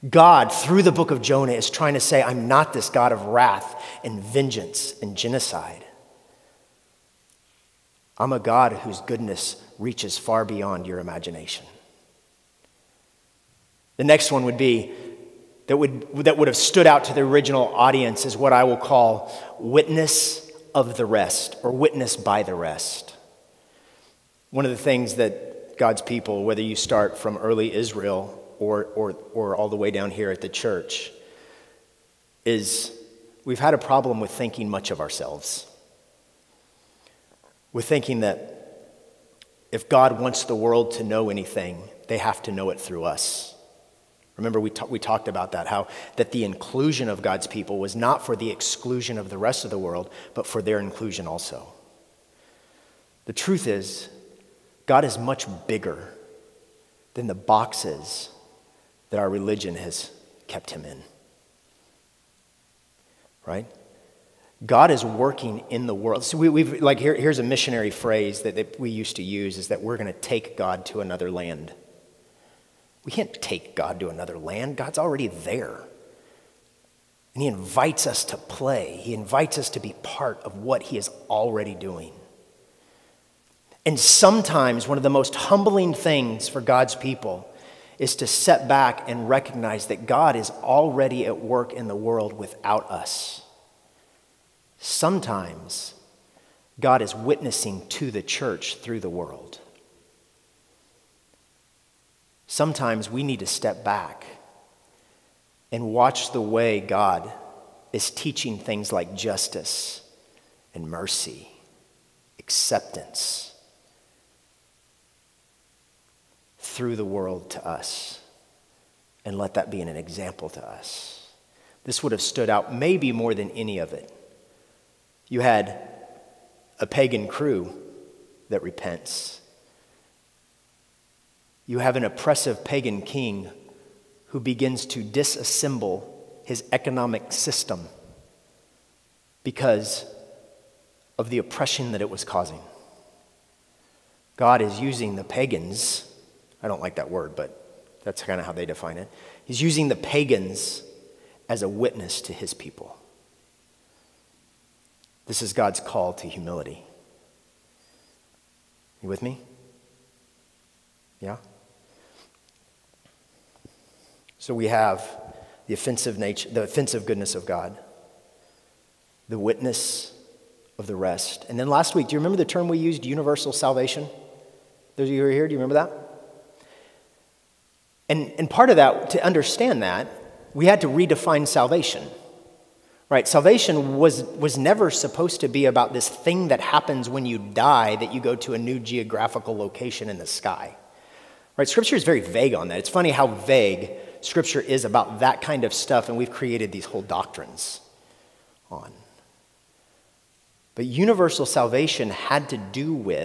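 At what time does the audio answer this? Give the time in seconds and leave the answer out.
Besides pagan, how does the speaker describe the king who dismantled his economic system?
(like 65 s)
132 s.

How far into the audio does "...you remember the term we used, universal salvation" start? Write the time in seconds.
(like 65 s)
172 s.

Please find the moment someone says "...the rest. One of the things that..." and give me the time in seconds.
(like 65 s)
22 s.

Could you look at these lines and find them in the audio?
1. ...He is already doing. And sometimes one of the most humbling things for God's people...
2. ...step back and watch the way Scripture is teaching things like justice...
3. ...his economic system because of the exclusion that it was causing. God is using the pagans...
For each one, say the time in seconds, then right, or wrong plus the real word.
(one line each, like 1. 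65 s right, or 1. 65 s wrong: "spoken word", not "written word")
1. 80 s right
2. 103 s wrong: "God", not "Scripture"
3. 136 s wrong: "oppression", not "exclusion".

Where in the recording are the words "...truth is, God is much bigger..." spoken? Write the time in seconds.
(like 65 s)
53 s.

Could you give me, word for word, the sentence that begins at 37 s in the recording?
With thinking that if God wants the world to know anything, they have to know it through us.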